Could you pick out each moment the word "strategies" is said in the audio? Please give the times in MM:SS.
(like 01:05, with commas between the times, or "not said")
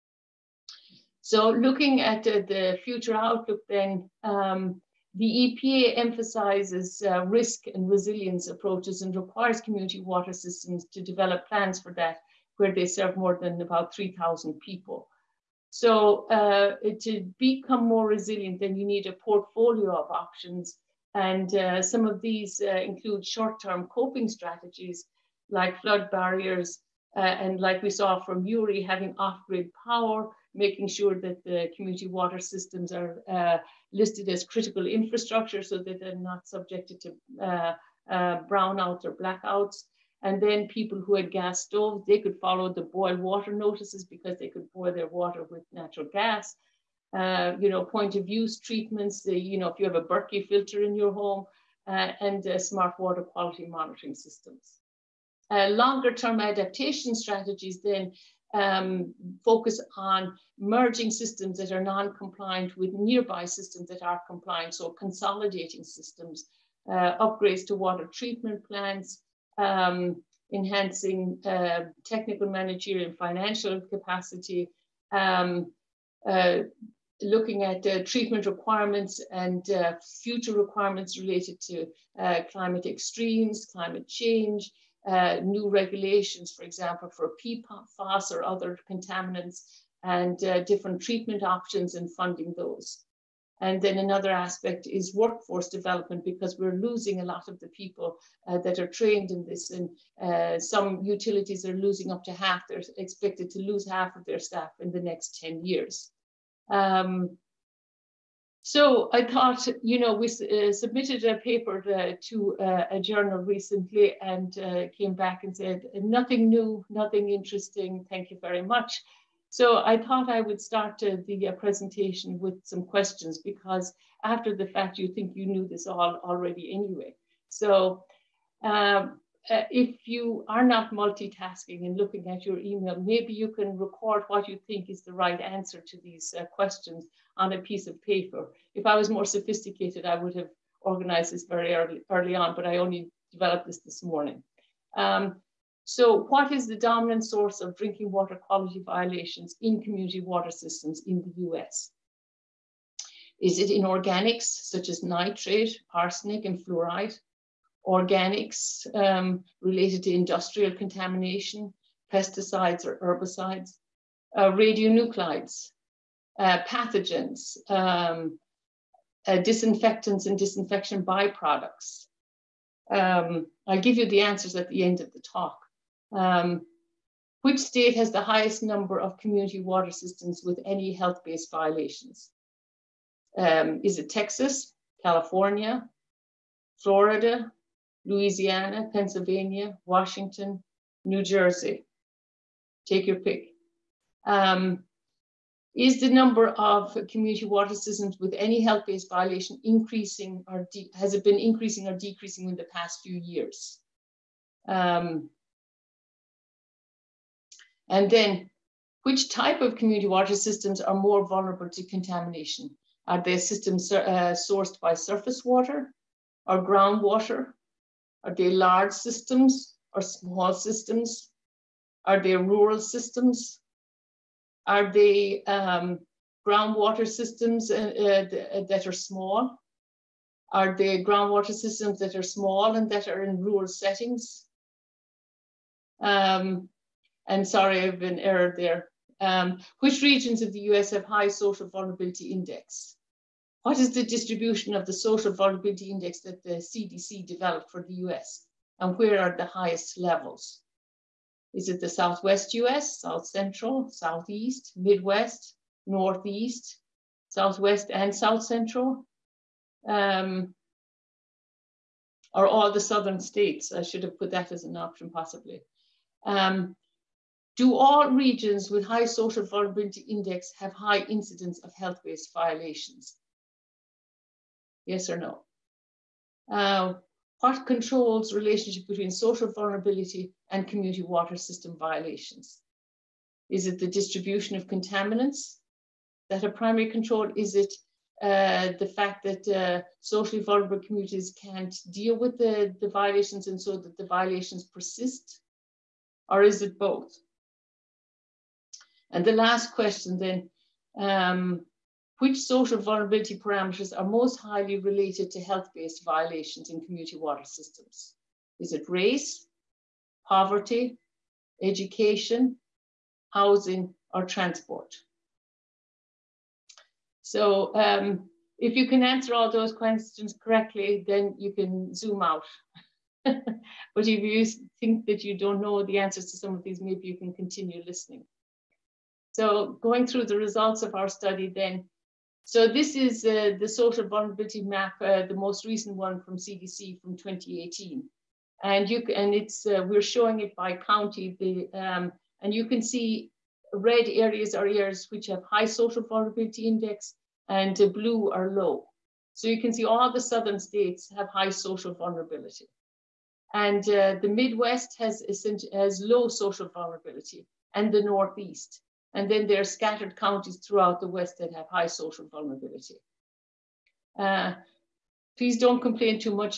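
00:24, 00:57.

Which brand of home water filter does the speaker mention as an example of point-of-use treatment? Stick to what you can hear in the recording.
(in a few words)
Berkey.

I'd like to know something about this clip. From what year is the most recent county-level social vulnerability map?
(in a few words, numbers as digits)
2018.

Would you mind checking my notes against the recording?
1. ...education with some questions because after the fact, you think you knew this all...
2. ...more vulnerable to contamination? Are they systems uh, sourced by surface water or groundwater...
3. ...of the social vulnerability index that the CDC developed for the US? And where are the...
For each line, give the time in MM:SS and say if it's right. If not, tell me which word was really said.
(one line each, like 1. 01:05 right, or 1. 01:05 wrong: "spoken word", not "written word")
1. 02:01 wrong: "presentation", not "education"
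2. 03:30 right
3. 04:04 right.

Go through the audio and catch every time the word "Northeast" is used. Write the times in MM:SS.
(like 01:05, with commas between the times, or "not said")
04:15, 05:58.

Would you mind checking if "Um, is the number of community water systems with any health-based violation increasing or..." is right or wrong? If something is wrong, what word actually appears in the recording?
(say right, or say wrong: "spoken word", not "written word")
right.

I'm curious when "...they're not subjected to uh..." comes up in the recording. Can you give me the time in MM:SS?
00:35.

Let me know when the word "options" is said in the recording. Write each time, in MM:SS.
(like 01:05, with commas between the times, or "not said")
00:20, 01:31, 04:24.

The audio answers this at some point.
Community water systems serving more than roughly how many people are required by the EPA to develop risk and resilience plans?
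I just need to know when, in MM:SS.
00:13.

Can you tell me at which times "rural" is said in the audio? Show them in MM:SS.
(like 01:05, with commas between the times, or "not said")
03:42, 03:53.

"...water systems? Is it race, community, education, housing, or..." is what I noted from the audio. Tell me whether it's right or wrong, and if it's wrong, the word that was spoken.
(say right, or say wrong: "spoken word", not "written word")
wrong: "poverty", not "community".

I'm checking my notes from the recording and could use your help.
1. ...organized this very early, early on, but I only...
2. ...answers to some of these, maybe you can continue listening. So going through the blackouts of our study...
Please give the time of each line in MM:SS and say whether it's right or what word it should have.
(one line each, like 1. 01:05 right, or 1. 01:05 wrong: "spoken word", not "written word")
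1. 02:20 right
2. 05:25 wrong: "results", not "blackouts".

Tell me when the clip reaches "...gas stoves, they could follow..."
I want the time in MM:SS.
00:41.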